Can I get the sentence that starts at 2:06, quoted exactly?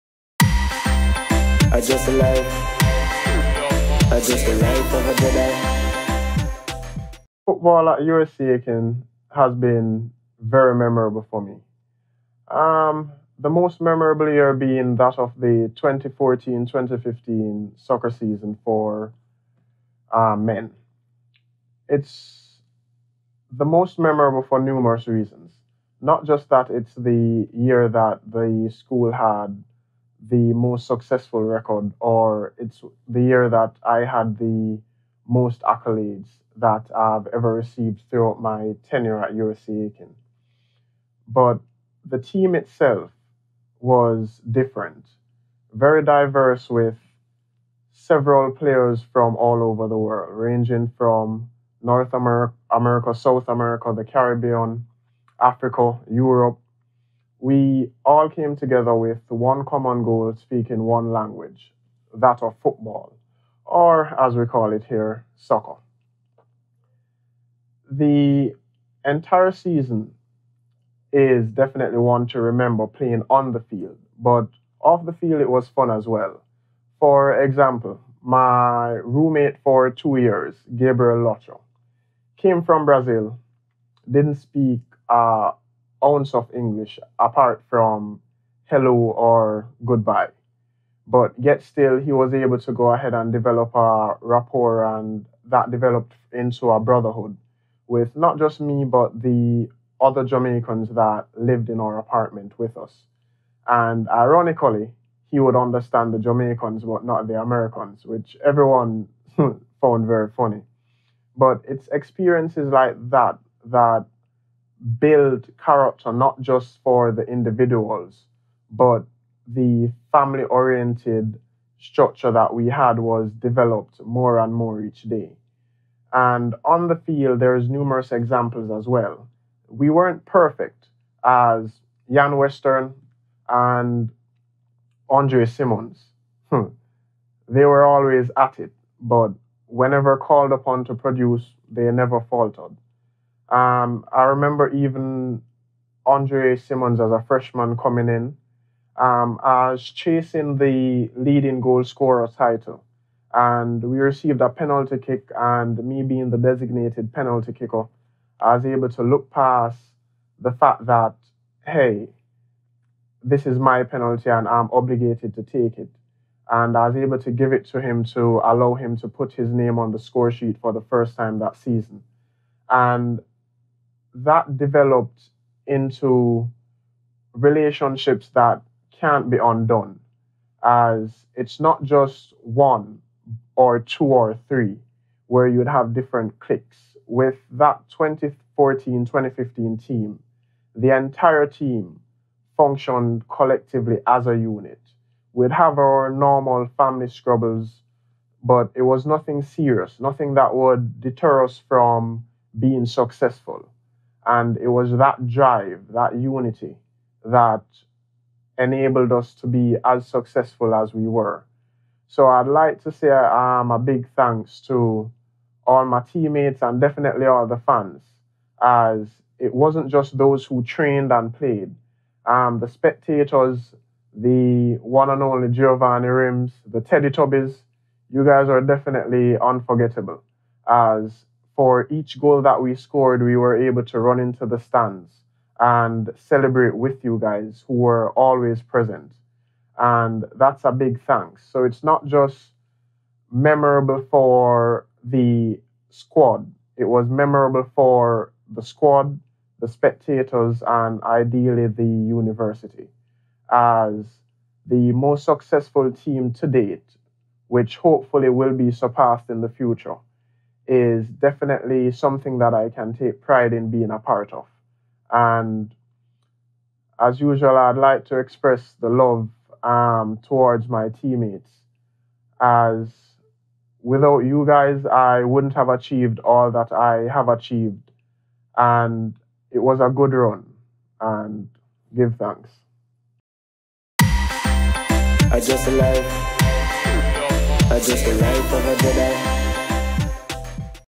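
And on the field, there's numerous examples as well.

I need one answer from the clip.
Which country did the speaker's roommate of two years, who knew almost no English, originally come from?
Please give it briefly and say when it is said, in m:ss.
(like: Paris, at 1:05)
Brazil, at 1:22.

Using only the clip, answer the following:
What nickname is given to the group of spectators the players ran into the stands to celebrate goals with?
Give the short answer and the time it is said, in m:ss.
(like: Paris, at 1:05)
the Teddy Tubbies, at 3:46.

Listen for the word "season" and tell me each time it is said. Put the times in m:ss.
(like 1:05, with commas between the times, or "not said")
0:18, 1:09, 2:51.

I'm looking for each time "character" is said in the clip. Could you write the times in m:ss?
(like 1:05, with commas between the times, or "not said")
1:55.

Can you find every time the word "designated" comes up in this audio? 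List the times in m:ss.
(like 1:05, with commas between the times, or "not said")
2:36.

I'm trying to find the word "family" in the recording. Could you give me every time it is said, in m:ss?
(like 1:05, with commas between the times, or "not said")
2:00, 3:16.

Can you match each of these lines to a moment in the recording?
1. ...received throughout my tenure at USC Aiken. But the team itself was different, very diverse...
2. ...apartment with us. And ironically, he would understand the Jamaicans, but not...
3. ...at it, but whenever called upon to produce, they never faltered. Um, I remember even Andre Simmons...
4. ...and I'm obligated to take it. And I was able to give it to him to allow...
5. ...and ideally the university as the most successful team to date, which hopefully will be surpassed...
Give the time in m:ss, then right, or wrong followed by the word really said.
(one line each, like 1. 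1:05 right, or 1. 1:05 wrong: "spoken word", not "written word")
1. 0:37 right
2. 1:41 right
3. 2:18 right
4. 2:44 right
5. 4:10 right.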